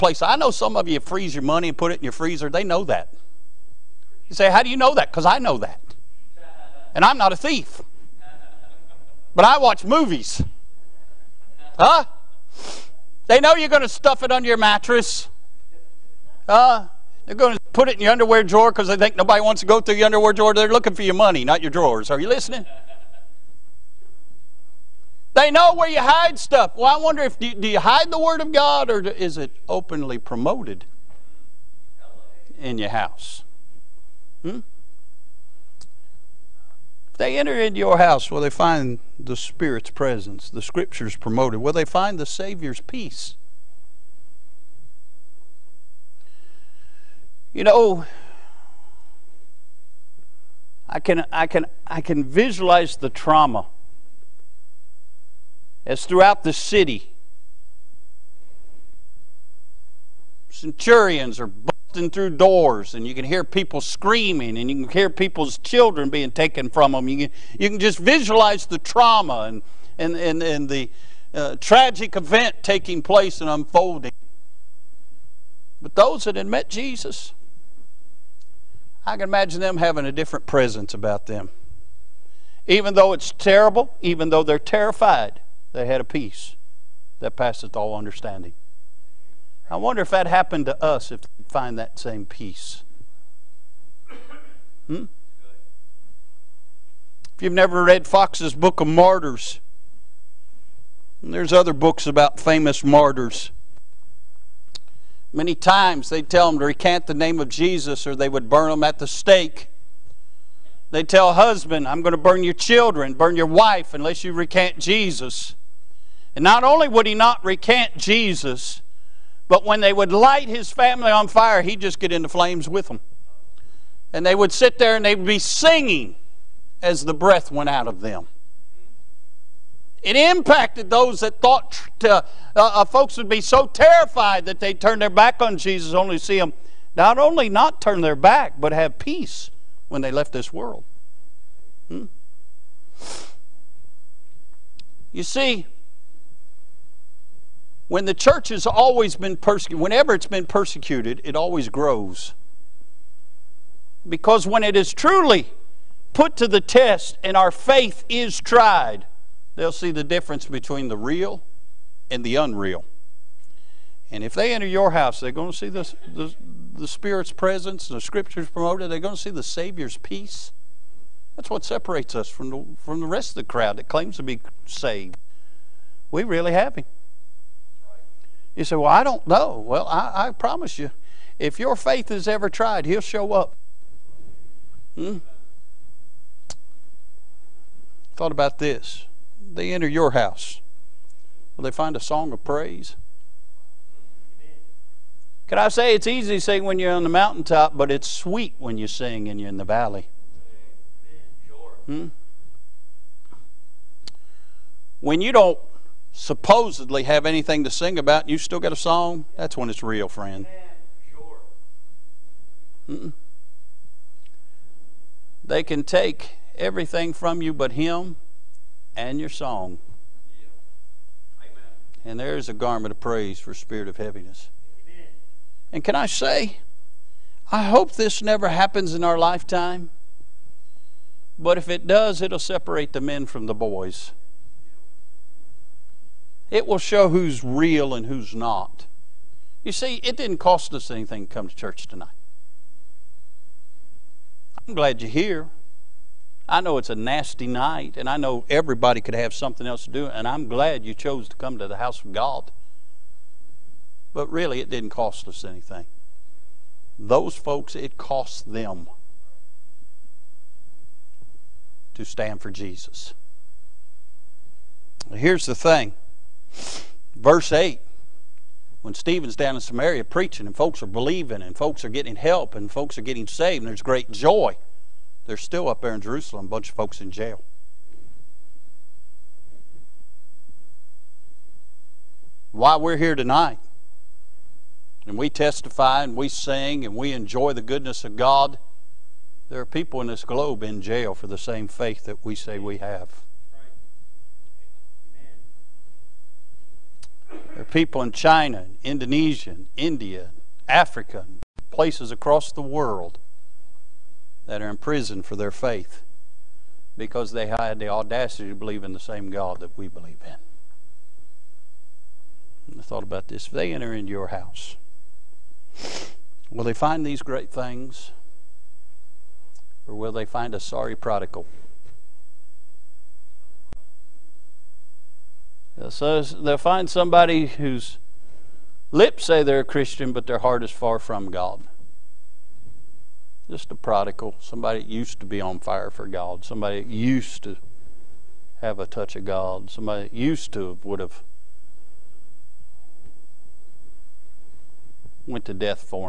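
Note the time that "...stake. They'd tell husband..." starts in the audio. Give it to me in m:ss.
1:49.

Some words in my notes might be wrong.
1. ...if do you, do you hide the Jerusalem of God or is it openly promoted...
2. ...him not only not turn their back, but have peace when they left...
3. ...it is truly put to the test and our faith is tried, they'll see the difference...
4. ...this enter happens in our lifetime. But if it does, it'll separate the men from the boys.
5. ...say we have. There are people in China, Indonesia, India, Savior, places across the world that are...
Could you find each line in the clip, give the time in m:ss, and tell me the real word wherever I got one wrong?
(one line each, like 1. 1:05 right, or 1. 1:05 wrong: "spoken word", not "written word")
1. 0:27 wrong: "Word", not "Jerusalem"
2. 2:16 right
3. 2:34 right
4. 3:47 wrong: "never", not "enter"
5. 4:52 wrong: "Africa", not "Savior".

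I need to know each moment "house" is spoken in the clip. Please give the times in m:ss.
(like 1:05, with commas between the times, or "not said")
0:32, 0:37, 2:44, 3:10, 4:11, 5:14.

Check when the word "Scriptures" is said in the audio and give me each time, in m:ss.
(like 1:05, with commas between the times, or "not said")
0:40, 2:47.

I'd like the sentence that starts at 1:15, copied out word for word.
But those that had met Jesus, I can imagine them having a different presence about them.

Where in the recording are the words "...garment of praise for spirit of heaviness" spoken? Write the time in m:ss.
3:42.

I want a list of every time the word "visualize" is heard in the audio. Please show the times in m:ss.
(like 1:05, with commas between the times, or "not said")
0:52, 1:07.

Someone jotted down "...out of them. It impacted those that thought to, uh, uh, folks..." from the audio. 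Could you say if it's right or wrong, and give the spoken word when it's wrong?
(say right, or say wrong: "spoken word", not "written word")
right.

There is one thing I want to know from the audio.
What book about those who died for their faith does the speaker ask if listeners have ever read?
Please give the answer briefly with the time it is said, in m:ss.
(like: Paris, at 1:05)
Fox's Book of Martyrs, at 1:38.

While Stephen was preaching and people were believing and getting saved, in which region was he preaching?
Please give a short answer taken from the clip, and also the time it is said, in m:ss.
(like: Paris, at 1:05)
Samaria, at 4:29.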